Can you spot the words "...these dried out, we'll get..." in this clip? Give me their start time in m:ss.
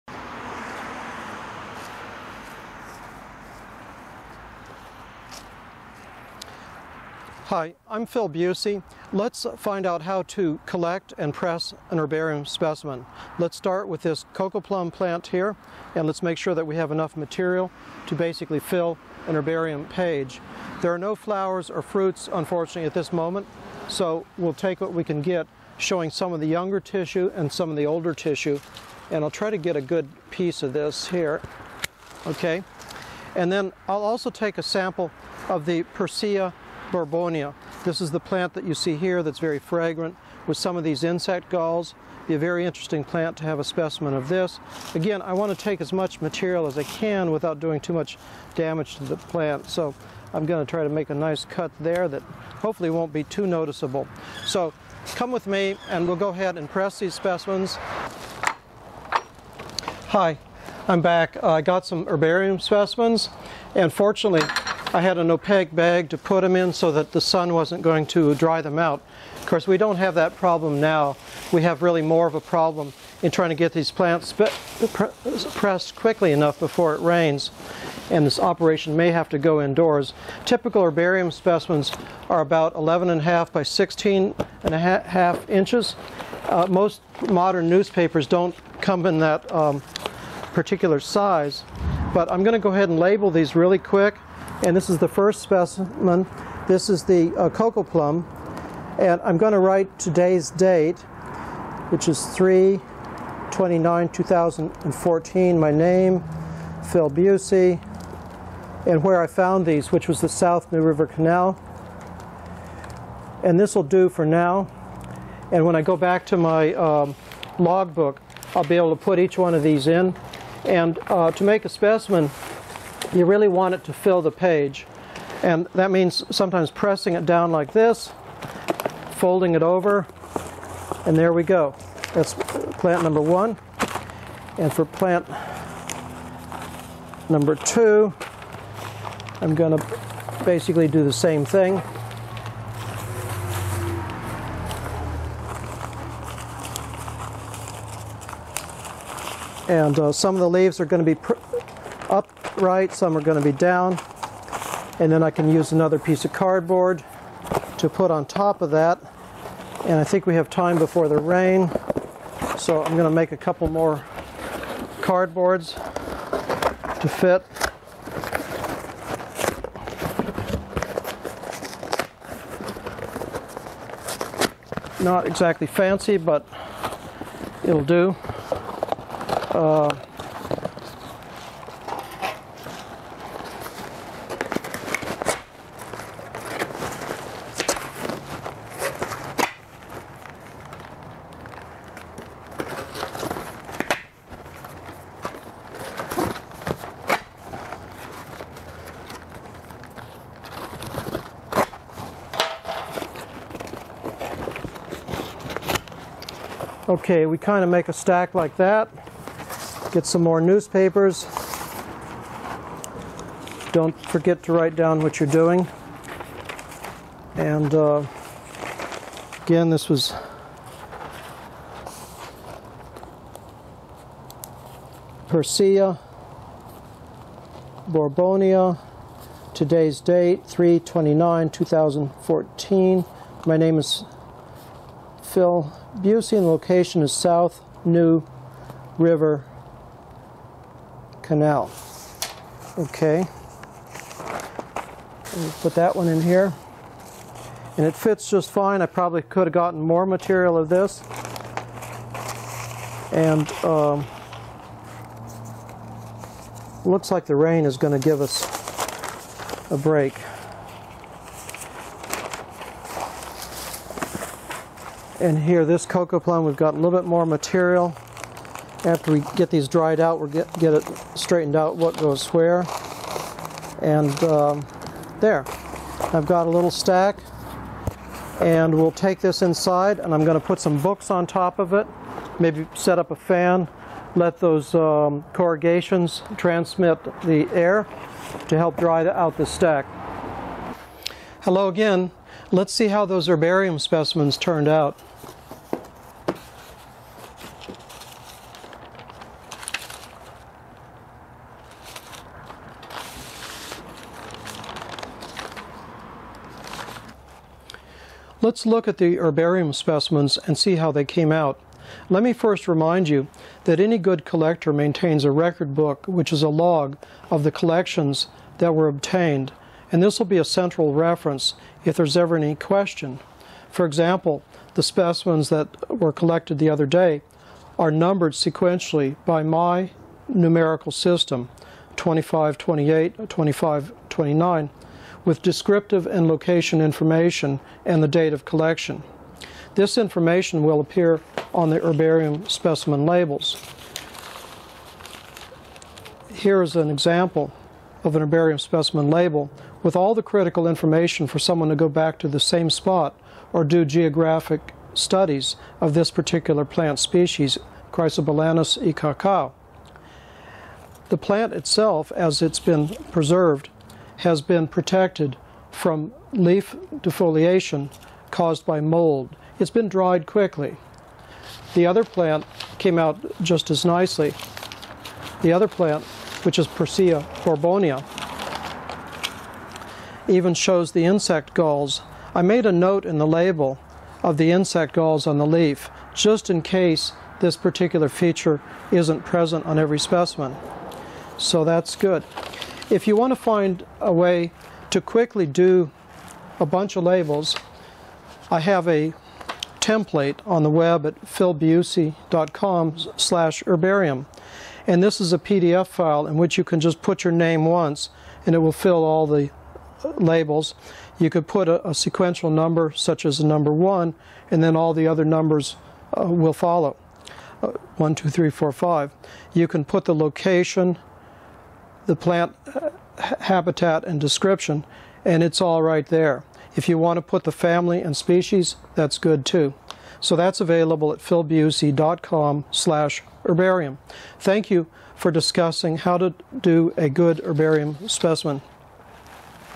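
4:29.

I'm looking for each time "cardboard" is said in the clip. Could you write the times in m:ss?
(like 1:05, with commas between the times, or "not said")
2:36, 2:44.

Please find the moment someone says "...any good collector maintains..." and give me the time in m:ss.
5:13.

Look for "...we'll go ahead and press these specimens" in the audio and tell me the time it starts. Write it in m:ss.
0:56.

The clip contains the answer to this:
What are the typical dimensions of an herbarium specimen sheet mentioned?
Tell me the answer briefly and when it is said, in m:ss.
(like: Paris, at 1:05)
11.5 by 16.5 inches, at 1:22.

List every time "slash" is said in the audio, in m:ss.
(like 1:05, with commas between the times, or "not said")
6:43, 7:12.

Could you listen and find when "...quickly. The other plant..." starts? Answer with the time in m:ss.
6:10.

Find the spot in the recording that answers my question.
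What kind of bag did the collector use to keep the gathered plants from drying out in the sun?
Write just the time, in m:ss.
1:05.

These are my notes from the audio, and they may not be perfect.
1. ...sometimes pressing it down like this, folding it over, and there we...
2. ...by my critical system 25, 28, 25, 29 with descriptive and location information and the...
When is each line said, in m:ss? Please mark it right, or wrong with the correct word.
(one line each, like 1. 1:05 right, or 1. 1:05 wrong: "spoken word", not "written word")
1. 2:06 right
2. 5:29 wrong: "numerical", not "critical".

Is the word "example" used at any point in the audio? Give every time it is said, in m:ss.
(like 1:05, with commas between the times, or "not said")
5:23, 5:46.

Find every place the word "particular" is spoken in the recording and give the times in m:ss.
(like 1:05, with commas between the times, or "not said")
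1:30, 5:56, 6:27.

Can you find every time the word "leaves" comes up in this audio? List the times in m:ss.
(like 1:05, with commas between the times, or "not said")
2:30.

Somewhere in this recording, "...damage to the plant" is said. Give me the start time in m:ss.
0:48.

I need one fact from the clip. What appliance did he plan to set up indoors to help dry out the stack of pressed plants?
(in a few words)
a fan.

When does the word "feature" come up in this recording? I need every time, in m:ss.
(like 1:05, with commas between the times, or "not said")
6:28.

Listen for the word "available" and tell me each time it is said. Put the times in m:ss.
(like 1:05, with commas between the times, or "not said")
7:10.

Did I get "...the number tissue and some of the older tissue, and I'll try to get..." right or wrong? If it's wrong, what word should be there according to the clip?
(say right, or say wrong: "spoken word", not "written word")
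wrong: "younger", not "number".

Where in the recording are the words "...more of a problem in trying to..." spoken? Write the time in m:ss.
1:12.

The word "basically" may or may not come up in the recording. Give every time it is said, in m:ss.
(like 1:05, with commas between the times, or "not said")
0:18, 2:20.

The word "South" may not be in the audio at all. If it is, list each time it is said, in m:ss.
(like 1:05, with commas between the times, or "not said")
1:50, 3:57.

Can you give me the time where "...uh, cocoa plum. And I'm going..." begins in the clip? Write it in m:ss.
1:37.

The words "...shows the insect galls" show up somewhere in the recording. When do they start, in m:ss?
6:20.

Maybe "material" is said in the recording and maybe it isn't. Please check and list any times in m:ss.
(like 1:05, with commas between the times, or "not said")
0:17, 0:46, 4:10, 4:27.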